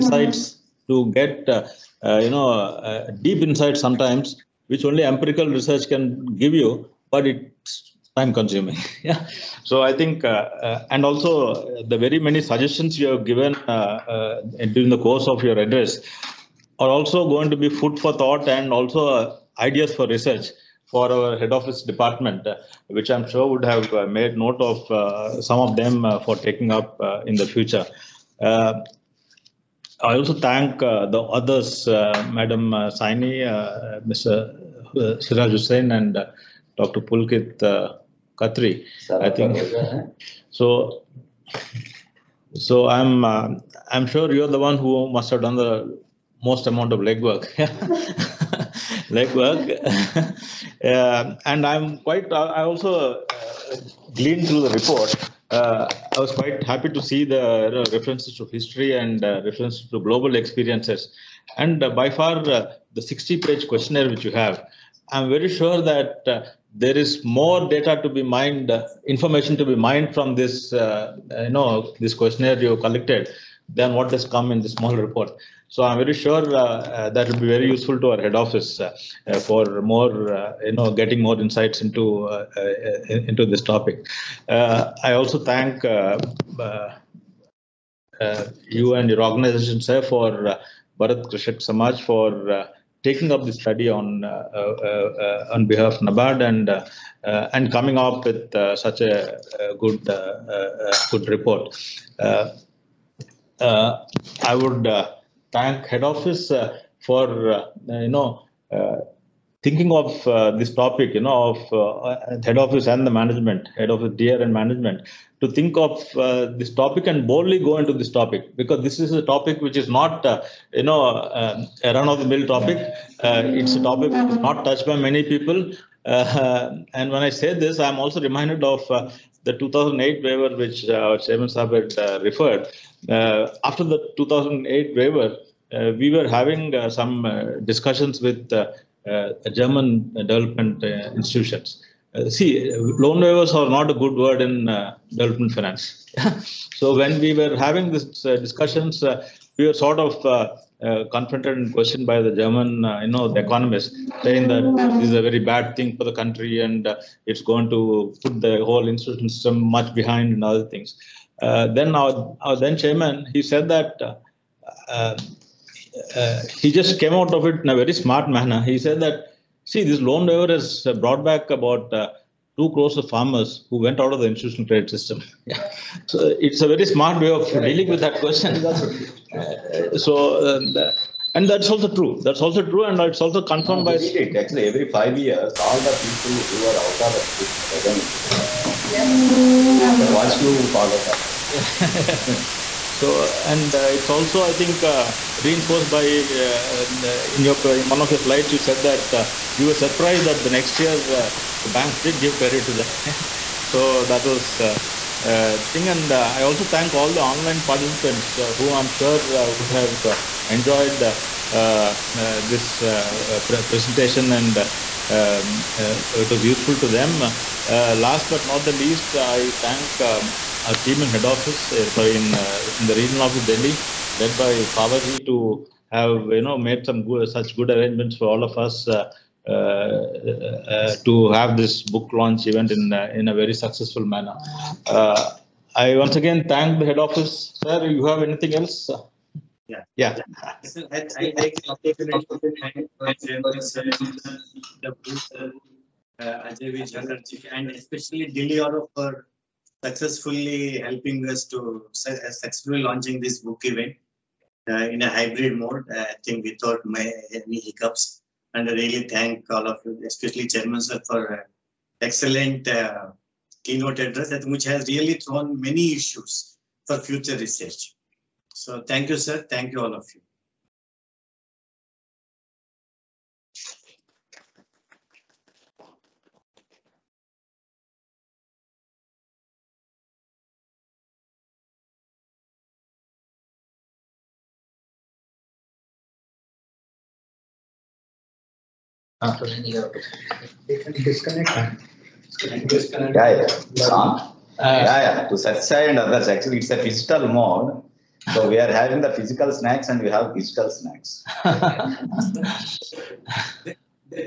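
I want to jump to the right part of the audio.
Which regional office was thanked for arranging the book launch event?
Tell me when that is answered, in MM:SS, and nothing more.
03:43.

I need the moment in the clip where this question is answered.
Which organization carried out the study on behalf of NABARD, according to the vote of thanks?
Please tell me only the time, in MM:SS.
01:30.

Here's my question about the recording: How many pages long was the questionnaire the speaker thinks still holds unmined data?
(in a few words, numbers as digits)
60.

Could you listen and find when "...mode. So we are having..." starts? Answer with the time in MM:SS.
04:57.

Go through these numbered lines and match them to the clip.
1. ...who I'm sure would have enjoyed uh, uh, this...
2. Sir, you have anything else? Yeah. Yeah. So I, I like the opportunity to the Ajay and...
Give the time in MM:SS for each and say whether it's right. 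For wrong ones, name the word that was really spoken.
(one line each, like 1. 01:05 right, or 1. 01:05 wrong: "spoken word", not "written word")
1. 03:28 right
2. 03:57 right.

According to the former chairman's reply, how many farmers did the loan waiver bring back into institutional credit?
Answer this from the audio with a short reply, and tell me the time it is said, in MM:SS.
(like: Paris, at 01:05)
2 crore, at 02:51.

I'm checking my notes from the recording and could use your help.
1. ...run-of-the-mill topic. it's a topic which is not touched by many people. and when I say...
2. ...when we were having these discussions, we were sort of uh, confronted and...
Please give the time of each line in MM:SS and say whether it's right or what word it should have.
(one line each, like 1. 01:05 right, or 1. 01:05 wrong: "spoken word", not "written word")
1. 02:01 right
2. 02:26 right.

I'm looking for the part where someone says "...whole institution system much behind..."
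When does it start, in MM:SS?
02:38.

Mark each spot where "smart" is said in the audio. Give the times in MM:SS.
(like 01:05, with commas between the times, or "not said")
02:47, 02:56.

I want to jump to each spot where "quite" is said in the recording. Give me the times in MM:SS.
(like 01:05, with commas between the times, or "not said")
00:51, 00:56.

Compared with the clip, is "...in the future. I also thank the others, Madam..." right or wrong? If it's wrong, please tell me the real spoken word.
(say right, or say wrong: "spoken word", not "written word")
right.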